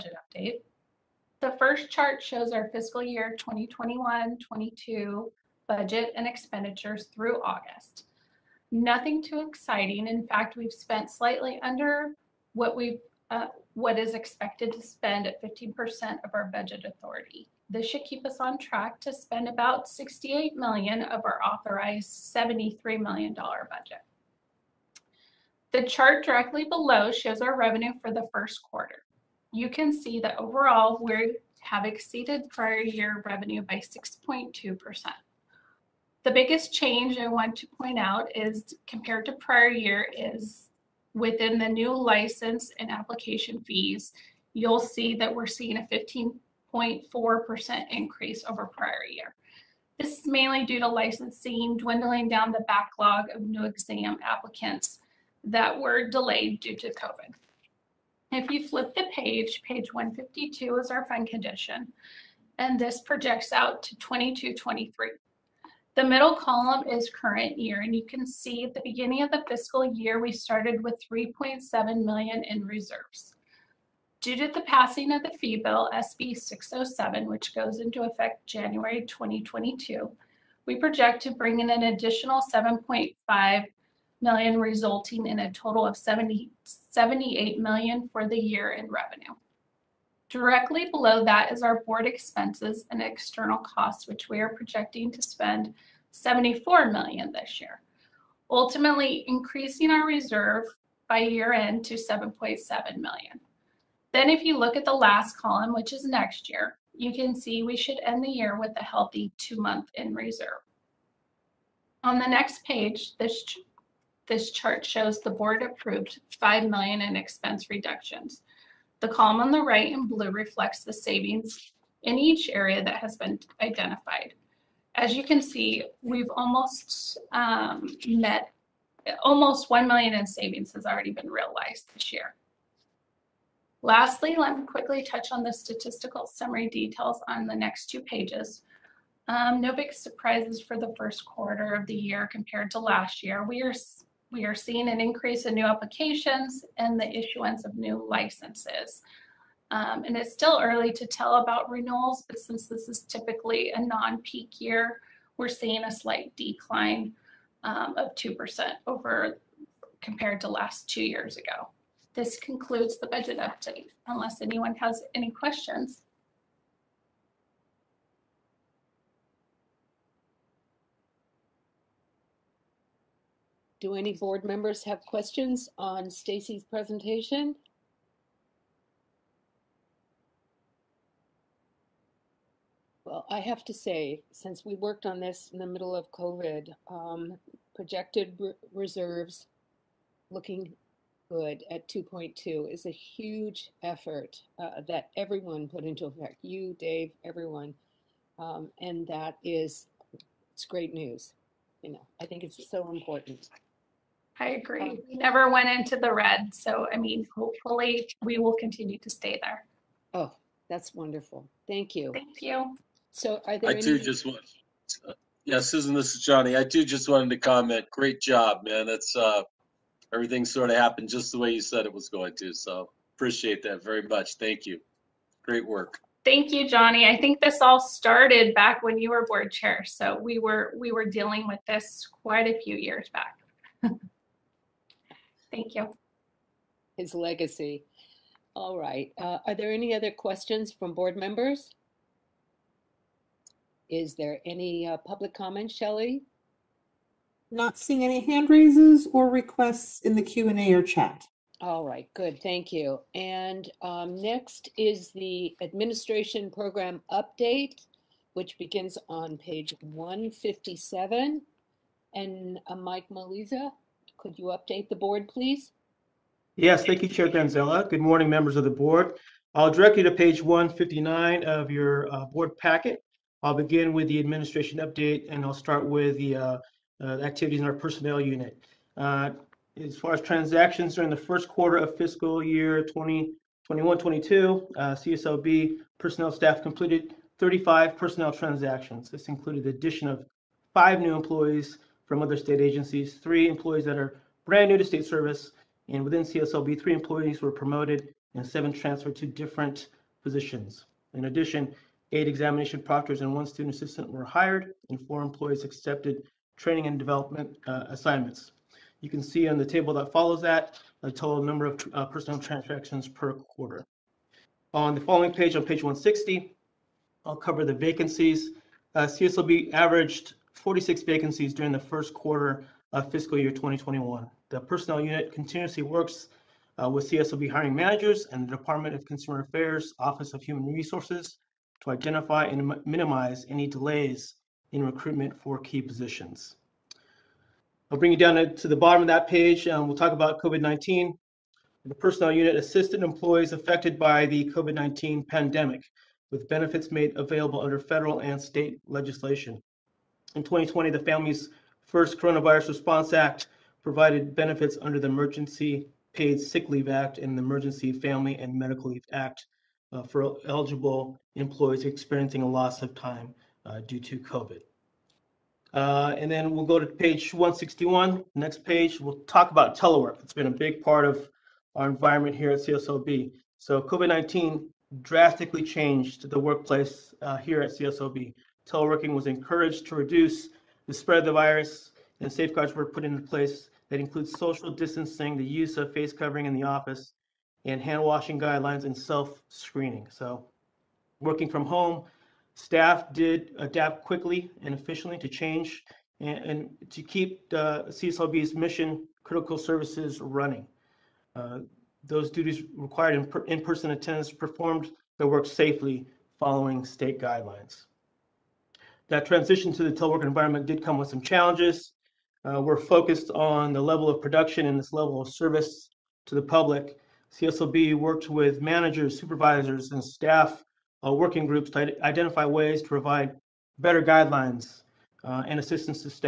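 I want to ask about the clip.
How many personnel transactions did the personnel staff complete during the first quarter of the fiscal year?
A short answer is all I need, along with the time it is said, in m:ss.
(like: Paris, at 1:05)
35, at 4:47.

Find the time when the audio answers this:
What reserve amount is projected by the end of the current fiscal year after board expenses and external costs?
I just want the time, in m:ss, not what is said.
1:41.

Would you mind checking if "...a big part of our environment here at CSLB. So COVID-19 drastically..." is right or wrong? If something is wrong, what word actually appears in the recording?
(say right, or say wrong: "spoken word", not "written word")
right.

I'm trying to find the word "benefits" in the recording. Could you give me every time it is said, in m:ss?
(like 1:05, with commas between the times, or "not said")
5:46, 5:54.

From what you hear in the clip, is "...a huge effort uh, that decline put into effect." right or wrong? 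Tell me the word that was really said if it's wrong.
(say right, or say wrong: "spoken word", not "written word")
wrong: "everyone", not "decline".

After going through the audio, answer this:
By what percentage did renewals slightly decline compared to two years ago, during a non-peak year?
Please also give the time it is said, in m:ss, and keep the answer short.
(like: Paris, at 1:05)
2%, at 2:38.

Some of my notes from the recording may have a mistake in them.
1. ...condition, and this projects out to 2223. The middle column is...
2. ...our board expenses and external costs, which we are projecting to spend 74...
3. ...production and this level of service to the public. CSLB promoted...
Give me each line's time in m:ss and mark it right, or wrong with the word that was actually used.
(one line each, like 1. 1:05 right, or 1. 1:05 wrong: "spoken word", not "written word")
1. 1:01 right
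2. 1:31 right
3. 6:54 wrong: "worked", not "promoted".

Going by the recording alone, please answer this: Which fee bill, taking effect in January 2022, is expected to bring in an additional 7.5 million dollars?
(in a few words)
SB 607.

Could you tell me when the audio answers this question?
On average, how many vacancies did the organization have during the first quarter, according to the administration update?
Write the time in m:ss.
5:20.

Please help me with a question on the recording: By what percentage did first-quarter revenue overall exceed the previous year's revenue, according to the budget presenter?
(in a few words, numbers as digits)
6.2%.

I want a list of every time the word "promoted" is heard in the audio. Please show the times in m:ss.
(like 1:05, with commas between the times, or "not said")
4:57.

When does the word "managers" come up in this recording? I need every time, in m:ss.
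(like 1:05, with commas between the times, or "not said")
5:27, 6:58.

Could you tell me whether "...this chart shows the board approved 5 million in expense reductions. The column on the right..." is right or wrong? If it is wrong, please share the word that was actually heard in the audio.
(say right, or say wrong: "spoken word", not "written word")
right.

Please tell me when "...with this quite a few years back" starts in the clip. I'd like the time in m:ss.
3:51.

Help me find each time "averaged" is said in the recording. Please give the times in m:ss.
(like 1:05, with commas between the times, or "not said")
5:19.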